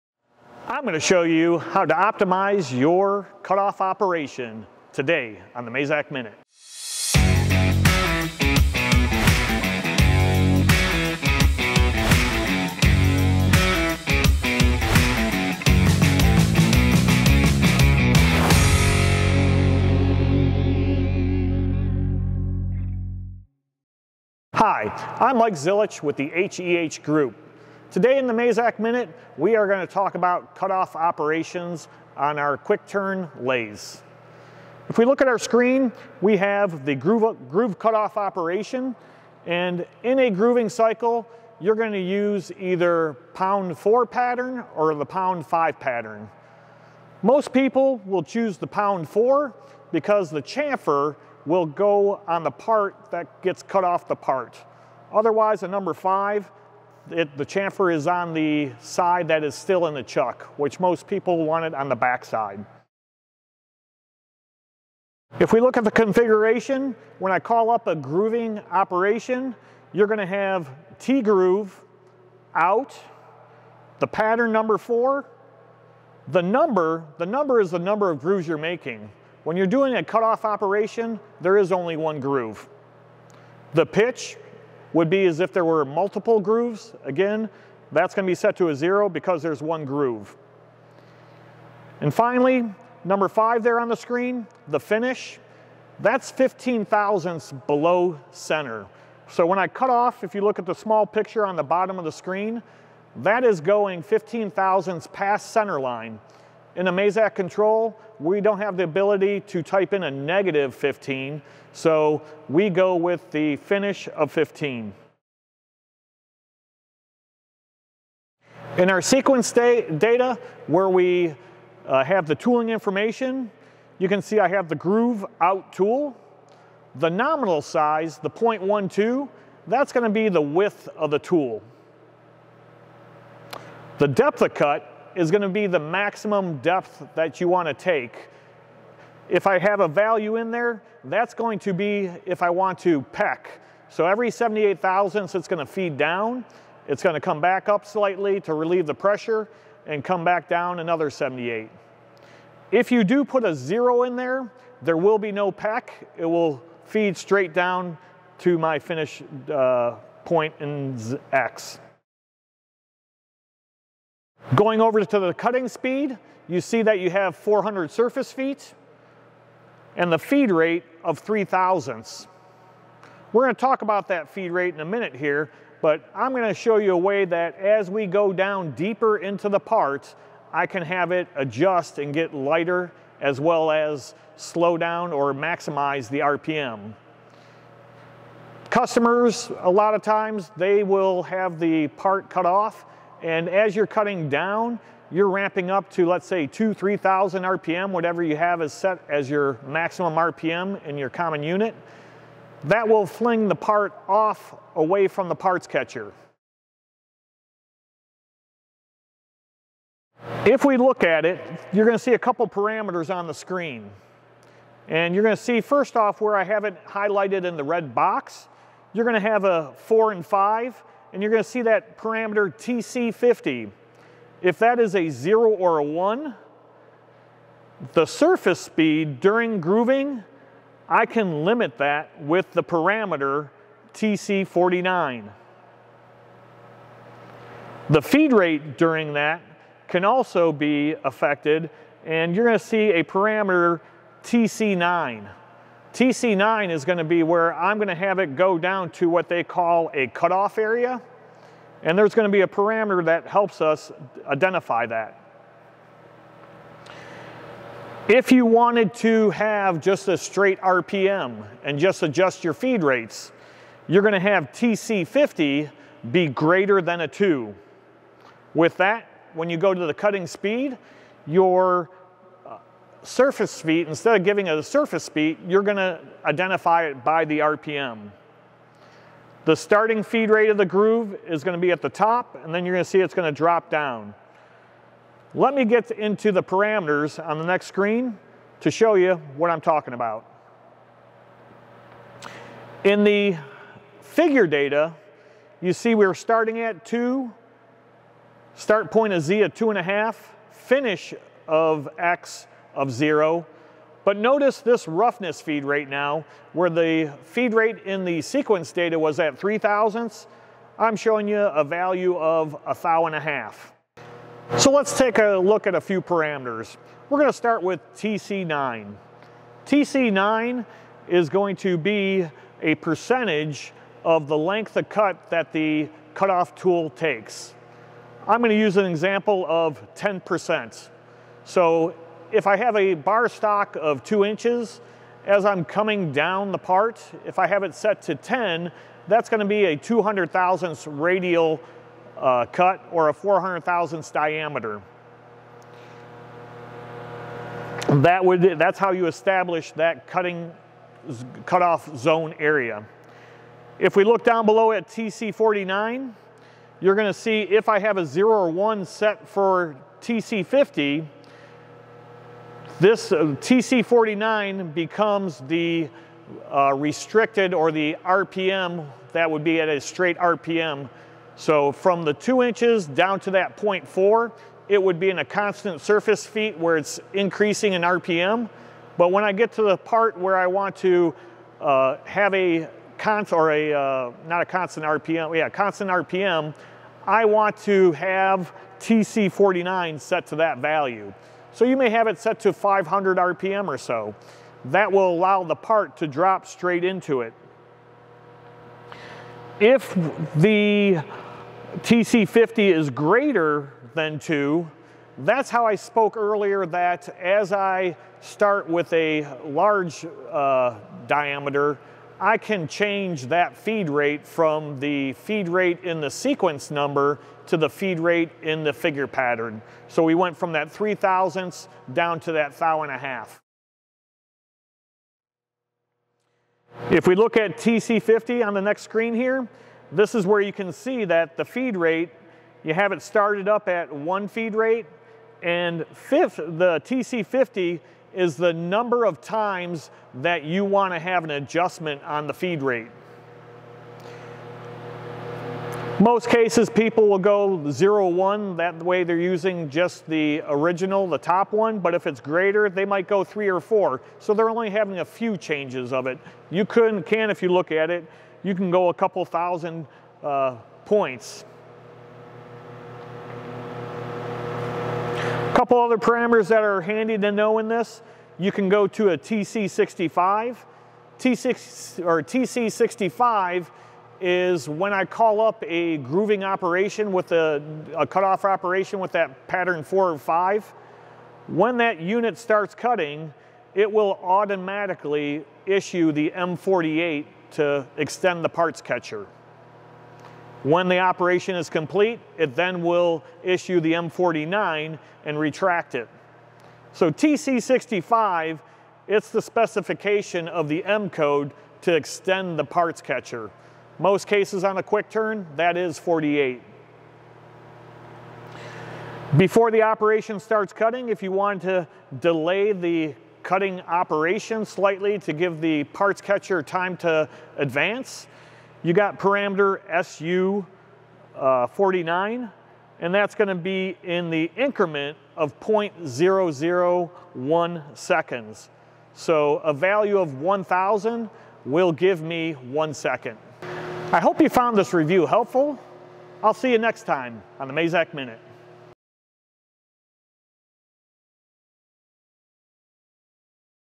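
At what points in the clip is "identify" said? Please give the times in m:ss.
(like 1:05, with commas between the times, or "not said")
4:14, 4:36.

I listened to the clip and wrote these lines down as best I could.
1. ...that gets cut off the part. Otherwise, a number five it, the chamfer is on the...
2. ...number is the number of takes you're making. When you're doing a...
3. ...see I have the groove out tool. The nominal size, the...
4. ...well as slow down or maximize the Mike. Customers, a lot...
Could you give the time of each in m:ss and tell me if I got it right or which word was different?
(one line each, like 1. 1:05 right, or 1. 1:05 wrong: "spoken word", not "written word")
1. 0:53 right
2. 1:17 wrong: "grooves", not "takes"
3. 2:04 right
4. 3:03 wrong: "RPM", not "Mike".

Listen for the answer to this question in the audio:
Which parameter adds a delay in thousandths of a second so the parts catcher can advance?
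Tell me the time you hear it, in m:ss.
8:41.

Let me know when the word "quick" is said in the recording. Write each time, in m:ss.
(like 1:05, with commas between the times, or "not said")
0:32, 8:24.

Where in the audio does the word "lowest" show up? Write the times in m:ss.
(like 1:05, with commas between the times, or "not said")
not said.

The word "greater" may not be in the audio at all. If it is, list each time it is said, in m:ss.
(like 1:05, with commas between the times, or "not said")
4:26, 6:42, 7:32.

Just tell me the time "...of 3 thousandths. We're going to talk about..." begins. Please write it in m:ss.
2:51.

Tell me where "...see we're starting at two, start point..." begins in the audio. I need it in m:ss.
4:55.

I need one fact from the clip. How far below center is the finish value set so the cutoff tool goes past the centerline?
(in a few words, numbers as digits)
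15 thousandths.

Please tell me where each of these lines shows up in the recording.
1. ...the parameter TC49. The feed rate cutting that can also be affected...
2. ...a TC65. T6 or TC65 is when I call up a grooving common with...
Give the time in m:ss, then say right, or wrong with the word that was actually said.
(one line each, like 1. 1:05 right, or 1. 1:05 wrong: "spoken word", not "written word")
1. 3:52 wrong: "during", not "cutting"
2. 7:49 wrong: "operation", not "common".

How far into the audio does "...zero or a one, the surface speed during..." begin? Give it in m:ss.
3:45.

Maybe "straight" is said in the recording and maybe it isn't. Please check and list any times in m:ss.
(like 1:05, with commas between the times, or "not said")
2:37, 4:20, 6:09, 6:36.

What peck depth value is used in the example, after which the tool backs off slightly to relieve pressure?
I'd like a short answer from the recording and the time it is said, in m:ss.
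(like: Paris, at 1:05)
78 thousandths, at 2:24.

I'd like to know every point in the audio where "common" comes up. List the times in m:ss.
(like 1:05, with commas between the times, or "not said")
3:21.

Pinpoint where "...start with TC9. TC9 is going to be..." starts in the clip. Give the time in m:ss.
5:17.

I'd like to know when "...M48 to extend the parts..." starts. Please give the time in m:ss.
8:06.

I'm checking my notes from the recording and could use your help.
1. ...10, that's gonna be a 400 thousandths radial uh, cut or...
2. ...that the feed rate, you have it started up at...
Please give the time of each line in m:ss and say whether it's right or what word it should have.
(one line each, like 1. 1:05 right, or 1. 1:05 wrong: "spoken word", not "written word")
1. 5:38 wrong: "200", not "400"
2. 7:11 right.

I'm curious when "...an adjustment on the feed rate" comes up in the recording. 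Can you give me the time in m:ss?
7:21.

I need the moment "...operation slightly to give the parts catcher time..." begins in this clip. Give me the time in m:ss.
8:33.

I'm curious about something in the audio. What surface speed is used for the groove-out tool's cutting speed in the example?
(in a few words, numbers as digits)
400 surface feet.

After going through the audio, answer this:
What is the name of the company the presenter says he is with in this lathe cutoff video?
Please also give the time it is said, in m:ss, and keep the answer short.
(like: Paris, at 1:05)
HEH Group, at 0:26.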